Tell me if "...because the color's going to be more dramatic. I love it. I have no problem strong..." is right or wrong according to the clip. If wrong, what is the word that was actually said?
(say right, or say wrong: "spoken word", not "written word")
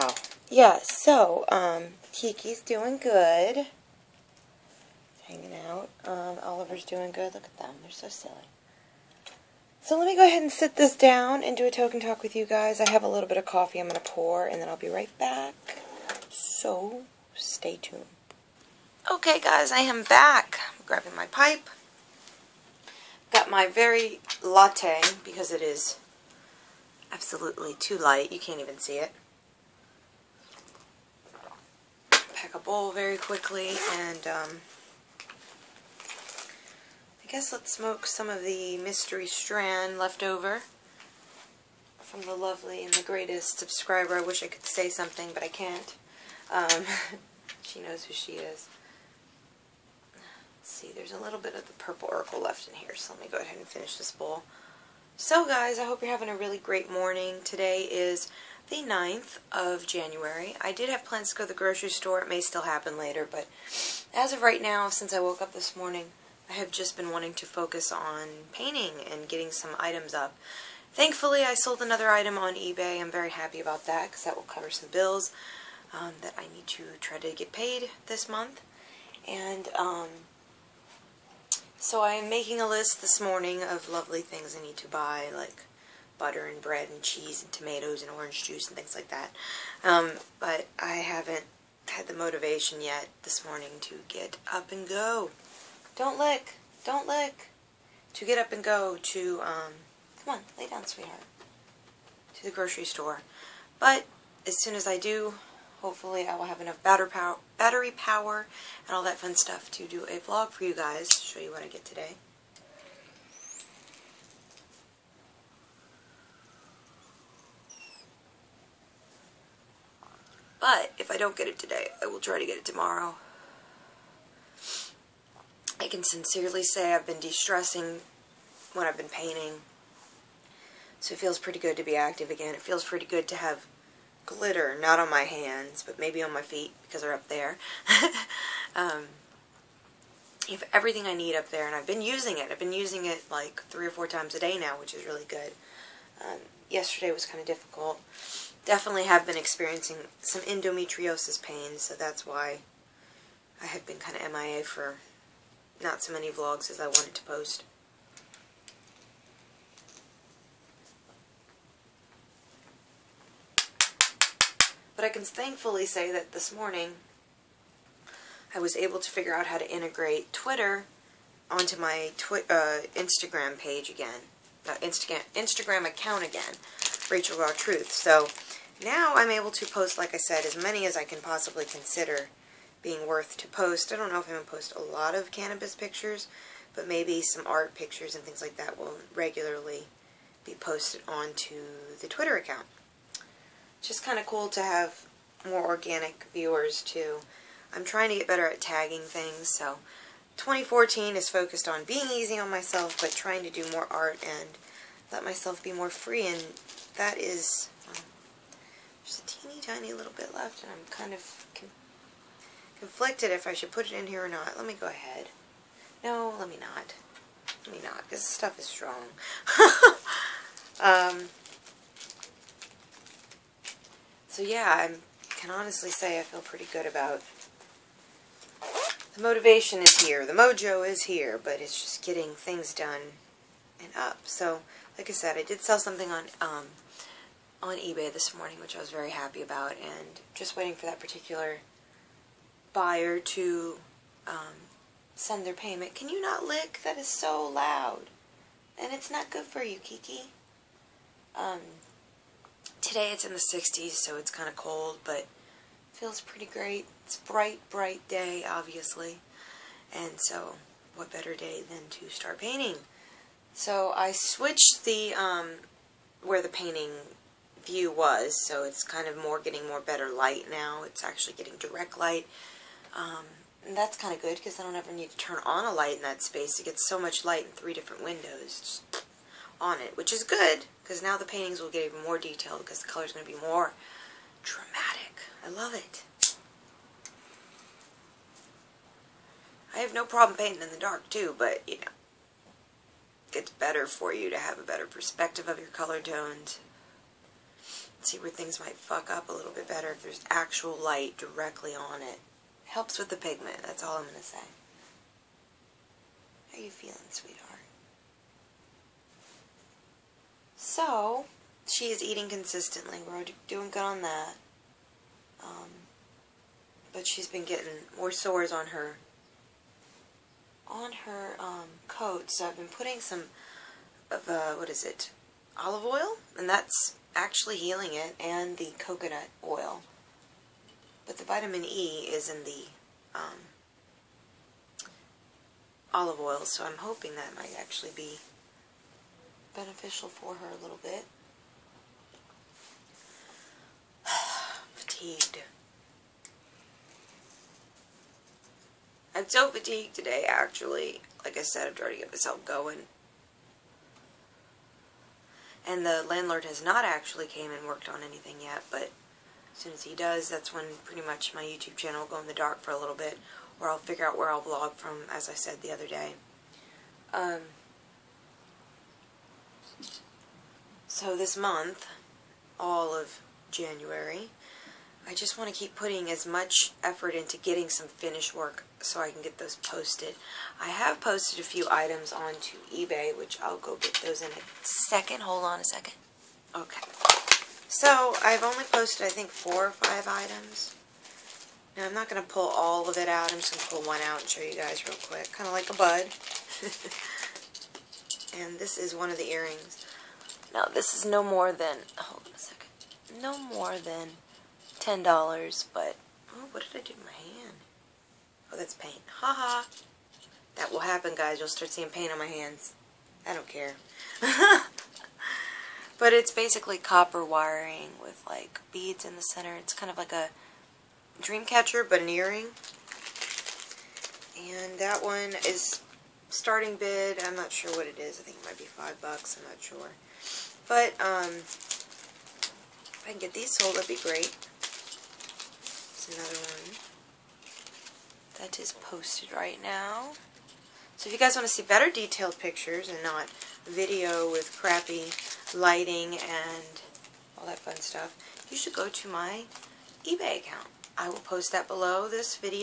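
wrong: "painting", not "strong".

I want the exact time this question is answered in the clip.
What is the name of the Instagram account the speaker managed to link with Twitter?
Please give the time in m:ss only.
2:57.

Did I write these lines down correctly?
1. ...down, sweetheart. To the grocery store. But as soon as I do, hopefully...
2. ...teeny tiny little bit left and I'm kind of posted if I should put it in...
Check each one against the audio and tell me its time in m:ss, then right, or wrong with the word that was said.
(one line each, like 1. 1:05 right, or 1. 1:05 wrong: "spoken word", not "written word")
1. 1:40 right
2. 3:29 wrong: "conflicted", not "posted".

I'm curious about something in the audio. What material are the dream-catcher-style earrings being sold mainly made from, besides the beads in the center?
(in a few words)
Copper wiring.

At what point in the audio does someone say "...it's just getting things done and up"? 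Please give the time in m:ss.
3:51.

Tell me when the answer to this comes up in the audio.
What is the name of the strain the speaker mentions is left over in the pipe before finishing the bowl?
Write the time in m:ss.
0:51.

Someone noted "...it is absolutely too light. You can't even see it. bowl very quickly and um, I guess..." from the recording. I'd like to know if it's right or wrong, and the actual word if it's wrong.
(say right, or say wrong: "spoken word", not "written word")
right.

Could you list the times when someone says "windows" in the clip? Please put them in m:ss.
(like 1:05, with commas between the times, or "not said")
4:38.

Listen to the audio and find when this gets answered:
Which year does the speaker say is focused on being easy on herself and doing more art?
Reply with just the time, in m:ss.
3:20.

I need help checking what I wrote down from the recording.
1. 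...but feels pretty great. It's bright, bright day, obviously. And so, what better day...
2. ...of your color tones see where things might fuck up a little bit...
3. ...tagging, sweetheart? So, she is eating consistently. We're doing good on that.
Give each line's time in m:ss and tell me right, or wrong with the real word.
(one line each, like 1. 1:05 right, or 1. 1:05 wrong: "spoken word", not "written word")
1. 4:15 right
2. 4:55 right
3. 5:06 wrong: "feeling", not "tagging".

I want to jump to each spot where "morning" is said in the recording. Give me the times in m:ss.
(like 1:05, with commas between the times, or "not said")
0:56, 1:05, 1:23, 1:33, 2:46, 3:58.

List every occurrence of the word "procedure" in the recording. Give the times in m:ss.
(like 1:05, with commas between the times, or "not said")
not said.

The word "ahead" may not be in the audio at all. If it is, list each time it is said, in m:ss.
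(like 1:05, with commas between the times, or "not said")
0:10, 0:53, 3:34.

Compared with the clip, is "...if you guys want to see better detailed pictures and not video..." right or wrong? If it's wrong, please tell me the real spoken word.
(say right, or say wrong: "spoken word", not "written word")
right.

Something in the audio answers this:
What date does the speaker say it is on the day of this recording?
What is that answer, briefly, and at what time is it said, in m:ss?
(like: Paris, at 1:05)
9th of January, at 0:58.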